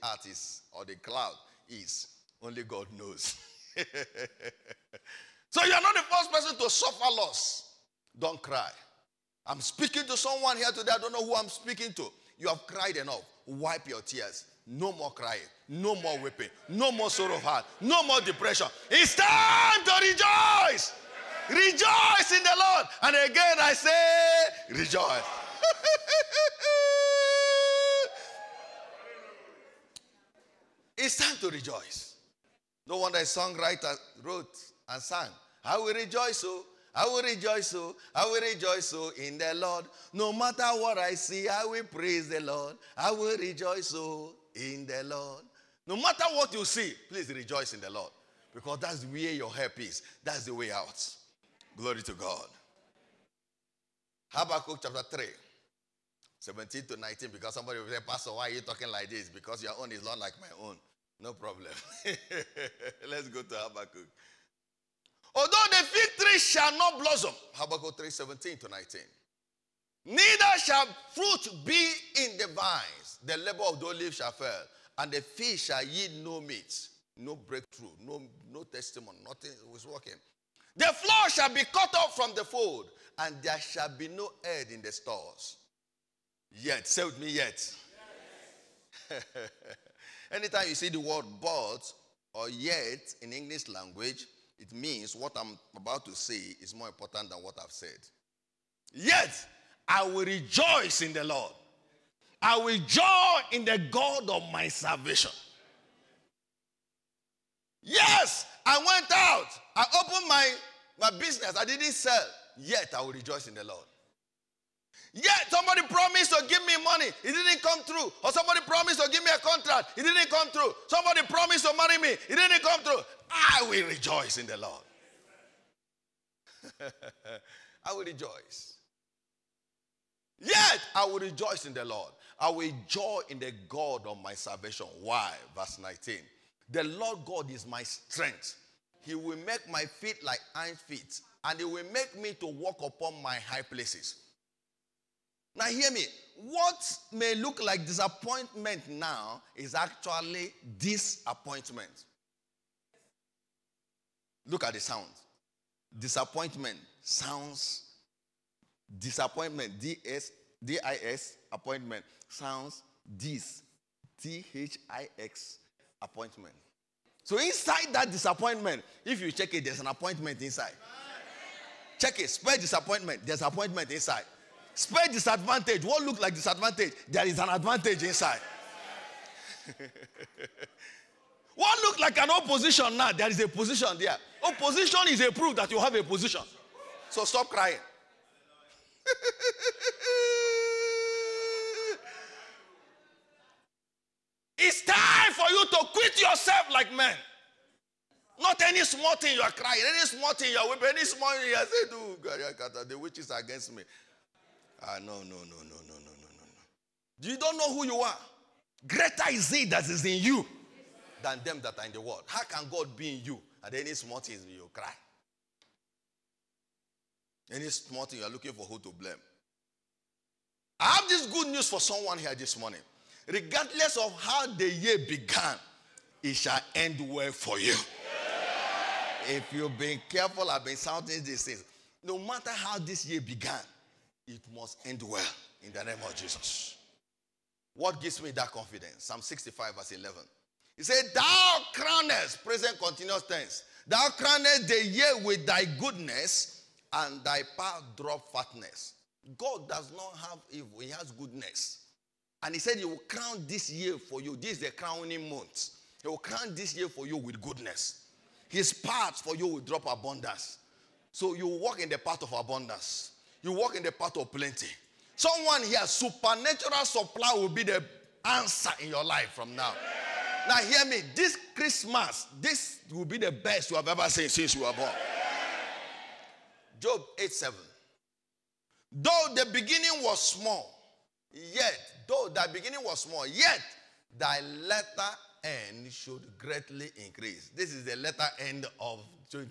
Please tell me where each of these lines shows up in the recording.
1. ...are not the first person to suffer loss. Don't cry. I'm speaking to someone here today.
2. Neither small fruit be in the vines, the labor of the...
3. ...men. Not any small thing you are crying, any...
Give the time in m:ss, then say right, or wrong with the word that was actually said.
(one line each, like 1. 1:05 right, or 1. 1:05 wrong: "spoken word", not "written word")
1. 0:05 right
2. 1:10 wrong: "shall", not "small"
3. 3:16 right.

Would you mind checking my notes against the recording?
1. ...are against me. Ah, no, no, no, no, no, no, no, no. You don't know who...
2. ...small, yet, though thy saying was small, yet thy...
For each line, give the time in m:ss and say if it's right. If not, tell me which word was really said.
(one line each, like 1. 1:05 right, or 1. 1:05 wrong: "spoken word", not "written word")
1. 3:23 right
2. 4:40 wrong: "beginning", not "saying".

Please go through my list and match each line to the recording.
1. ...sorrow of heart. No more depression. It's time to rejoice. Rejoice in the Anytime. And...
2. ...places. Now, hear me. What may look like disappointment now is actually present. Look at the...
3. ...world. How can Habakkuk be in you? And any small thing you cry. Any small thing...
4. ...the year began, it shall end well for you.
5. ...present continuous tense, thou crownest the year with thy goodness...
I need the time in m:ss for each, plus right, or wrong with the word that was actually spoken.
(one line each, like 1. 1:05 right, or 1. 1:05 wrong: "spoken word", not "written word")
1. 0:17 wrong: "Lord", not "Anytime"
2. 2:23 wrong: "disappointment", not "present"
3. 3:32 wrong: "God", not "Habakkuk"
4. 3:44 right
5. 4:02 right.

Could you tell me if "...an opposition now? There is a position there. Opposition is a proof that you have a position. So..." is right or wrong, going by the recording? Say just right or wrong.
right.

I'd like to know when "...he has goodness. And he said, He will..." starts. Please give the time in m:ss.
4:10.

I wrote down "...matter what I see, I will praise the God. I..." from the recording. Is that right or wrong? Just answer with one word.
wrong.